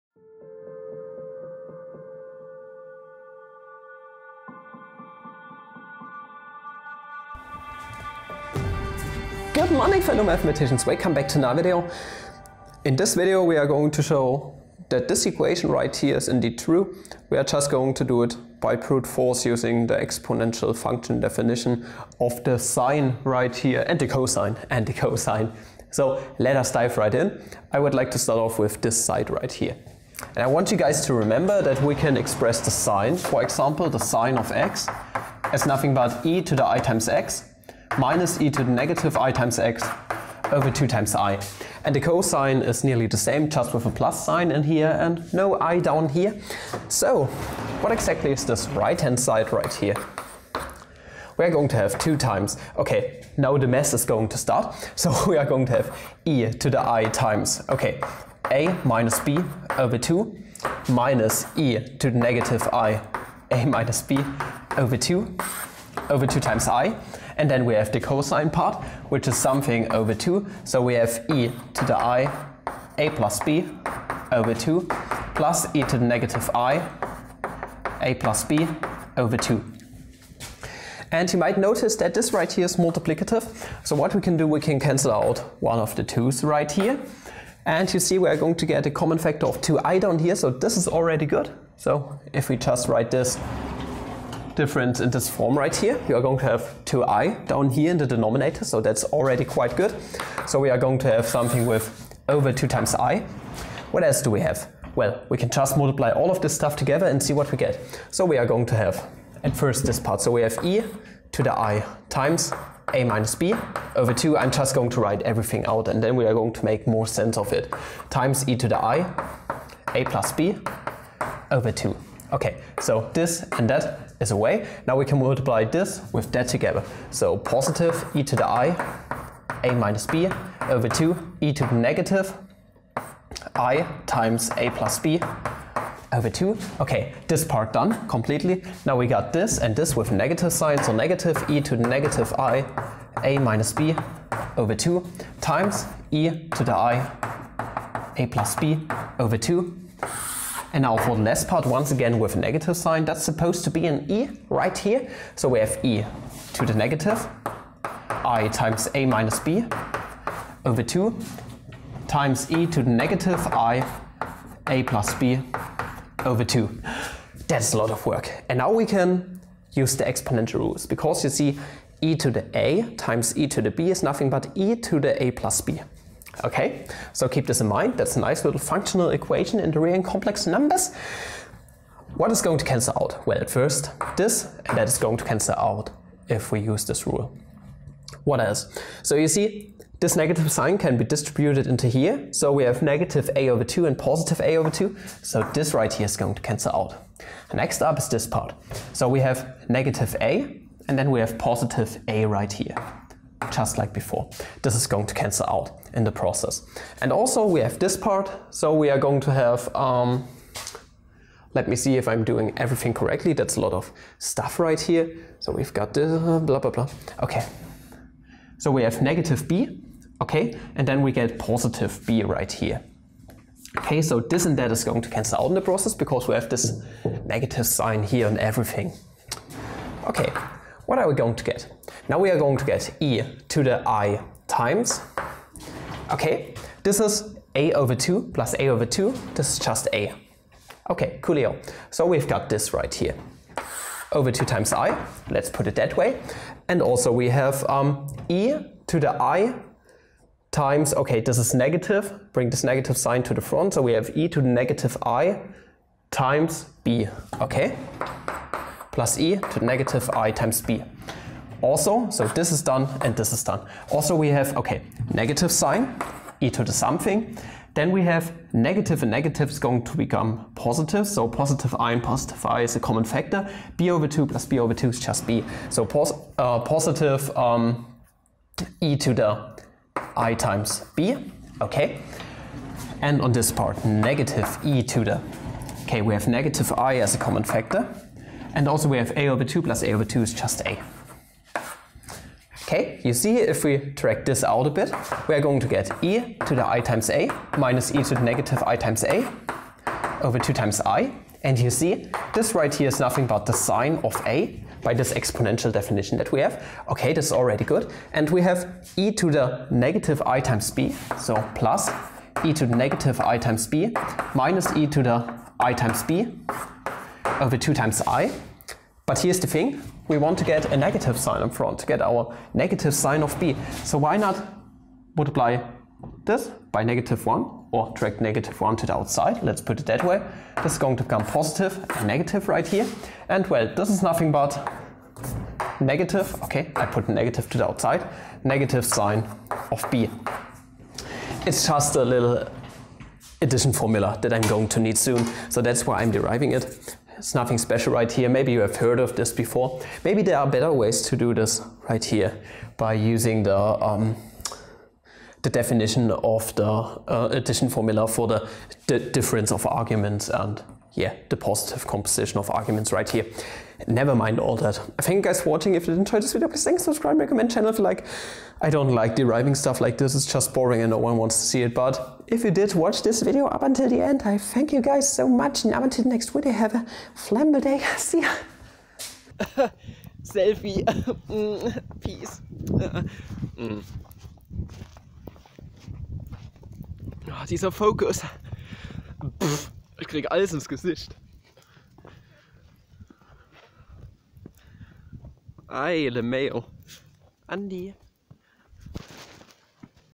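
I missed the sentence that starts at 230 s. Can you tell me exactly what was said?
Okay, what are we going to get?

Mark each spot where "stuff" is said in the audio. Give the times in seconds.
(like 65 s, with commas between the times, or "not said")
106 s, 214 s, 369 s.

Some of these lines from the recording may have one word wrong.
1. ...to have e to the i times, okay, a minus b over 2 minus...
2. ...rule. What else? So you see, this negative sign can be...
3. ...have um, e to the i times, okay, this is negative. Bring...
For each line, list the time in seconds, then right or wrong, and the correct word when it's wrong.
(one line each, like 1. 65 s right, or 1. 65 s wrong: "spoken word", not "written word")
1. 55 s right
2. 187 s right
3. 247 s right.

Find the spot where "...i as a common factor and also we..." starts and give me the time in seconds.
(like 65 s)
286 s.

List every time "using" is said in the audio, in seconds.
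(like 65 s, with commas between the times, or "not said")
19 s, 352 s.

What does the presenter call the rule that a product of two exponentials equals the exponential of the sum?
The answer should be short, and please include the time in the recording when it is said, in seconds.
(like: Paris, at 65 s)
functional equation, at 178 s.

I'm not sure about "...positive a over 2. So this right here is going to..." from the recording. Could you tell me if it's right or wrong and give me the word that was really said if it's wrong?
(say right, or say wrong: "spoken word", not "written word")
right.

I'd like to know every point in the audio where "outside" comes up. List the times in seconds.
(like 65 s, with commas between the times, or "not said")
328 s, 337 s.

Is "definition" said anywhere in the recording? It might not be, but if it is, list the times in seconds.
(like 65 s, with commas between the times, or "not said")
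21 s, 305 s, 355 s.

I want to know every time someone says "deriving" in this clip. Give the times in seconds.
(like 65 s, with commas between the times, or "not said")
346 s, 369 s.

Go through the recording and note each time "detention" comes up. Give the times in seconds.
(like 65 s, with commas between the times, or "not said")
not said.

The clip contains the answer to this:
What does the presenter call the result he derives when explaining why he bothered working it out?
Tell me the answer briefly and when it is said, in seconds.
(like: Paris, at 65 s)
little addition formula, at 342 s.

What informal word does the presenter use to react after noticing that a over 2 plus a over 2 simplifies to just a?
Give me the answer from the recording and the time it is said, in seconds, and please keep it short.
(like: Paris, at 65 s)
coolio, at 241 s.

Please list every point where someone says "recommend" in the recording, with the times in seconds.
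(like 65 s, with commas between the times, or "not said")
367 s.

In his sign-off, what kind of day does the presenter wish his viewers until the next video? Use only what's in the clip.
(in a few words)
flamble day.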